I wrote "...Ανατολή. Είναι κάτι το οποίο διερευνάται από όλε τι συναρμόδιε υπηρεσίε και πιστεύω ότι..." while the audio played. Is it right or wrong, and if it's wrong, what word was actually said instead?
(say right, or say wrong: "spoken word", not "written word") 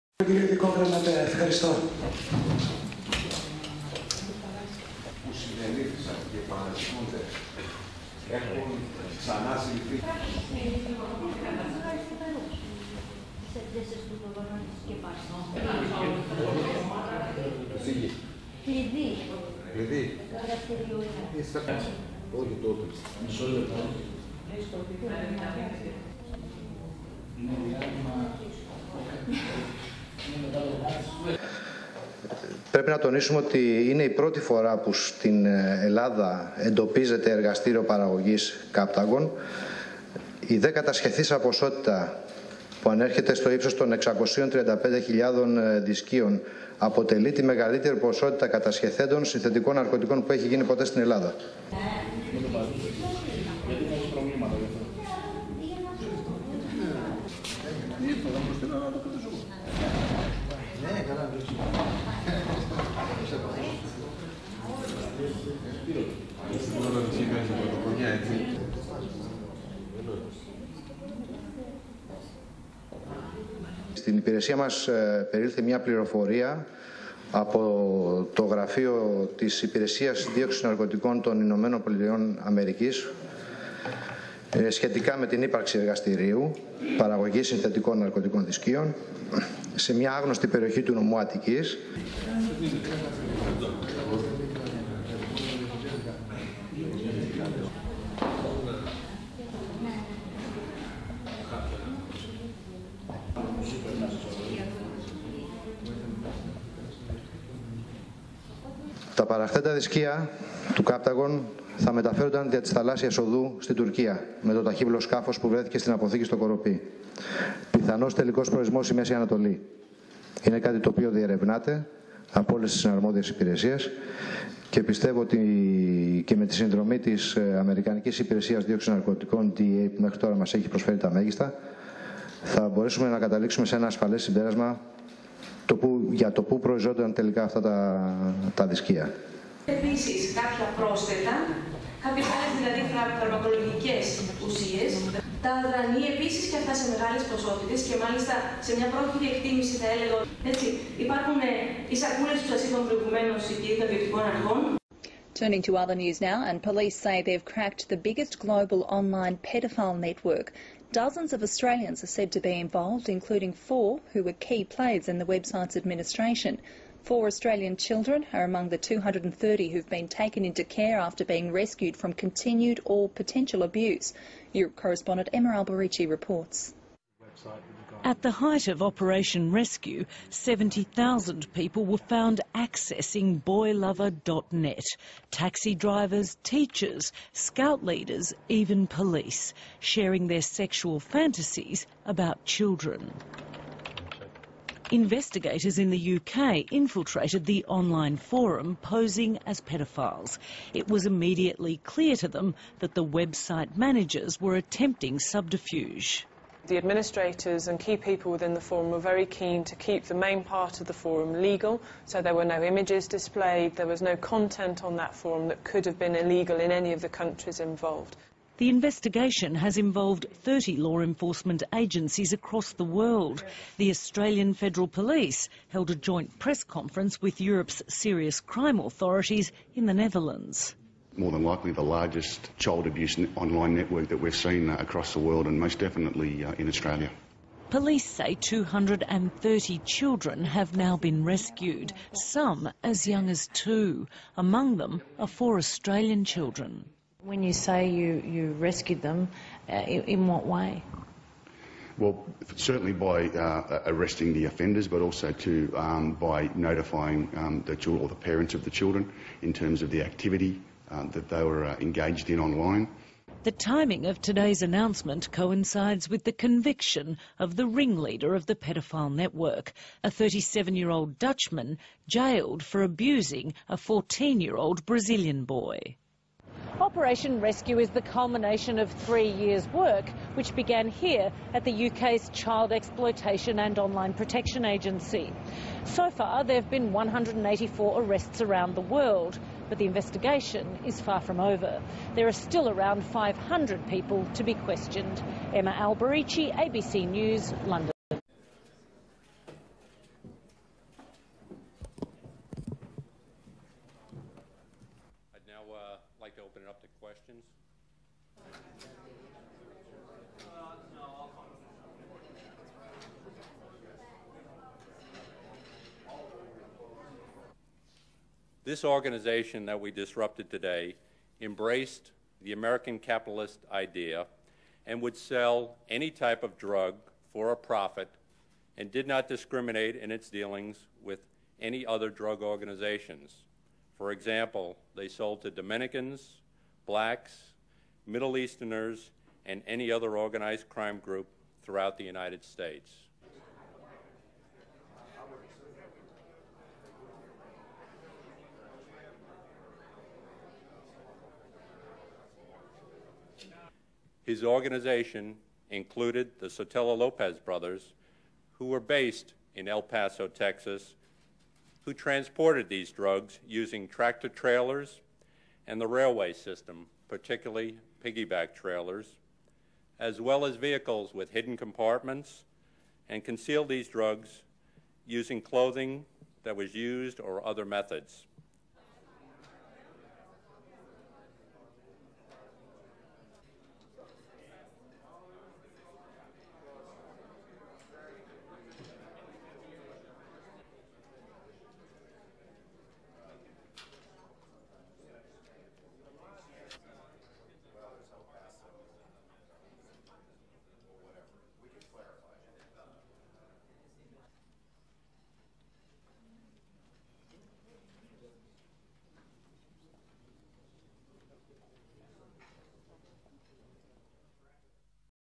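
right.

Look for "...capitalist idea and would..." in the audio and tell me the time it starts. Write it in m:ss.
5:22.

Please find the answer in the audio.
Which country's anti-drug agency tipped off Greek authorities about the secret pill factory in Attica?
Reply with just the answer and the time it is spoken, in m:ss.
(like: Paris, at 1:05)
United States, at 1:21.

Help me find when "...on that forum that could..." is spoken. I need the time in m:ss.
3:34.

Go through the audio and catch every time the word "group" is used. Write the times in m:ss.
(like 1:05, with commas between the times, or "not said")
5:40.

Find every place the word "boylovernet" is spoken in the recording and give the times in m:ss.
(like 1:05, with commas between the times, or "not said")
3:03.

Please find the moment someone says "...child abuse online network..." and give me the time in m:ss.
3:52.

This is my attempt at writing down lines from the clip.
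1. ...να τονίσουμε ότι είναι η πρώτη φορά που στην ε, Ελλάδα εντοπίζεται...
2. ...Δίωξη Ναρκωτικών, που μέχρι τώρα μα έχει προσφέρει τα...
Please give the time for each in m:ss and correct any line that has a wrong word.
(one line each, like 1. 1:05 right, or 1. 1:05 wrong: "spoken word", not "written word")
1. 0:32 right
2. 2:08 right.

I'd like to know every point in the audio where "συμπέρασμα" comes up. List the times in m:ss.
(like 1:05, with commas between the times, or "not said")
2:14.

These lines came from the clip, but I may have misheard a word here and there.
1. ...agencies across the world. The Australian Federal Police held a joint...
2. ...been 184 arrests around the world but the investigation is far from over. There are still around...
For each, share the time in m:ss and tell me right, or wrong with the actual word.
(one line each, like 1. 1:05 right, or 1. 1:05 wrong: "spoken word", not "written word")
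1. 3:41 right
2. 4:46 right.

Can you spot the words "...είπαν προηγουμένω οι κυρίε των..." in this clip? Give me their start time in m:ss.
2:32.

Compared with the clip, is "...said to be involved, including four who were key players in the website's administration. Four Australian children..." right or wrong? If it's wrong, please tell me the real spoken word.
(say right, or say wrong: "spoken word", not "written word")
right.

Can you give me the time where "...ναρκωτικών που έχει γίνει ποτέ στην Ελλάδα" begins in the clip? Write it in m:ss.
0:49.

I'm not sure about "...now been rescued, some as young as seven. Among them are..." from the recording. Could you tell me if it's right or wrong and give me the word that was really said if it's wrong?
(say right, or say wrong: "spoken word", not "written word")
wrong: "two", not "seven".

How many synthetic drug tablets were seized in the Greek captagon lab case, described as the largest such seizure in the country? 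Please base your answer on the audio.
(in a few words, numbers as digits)
635,000.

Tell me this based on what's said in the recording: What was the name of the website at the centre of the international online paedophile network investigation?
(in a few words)
boylover.net.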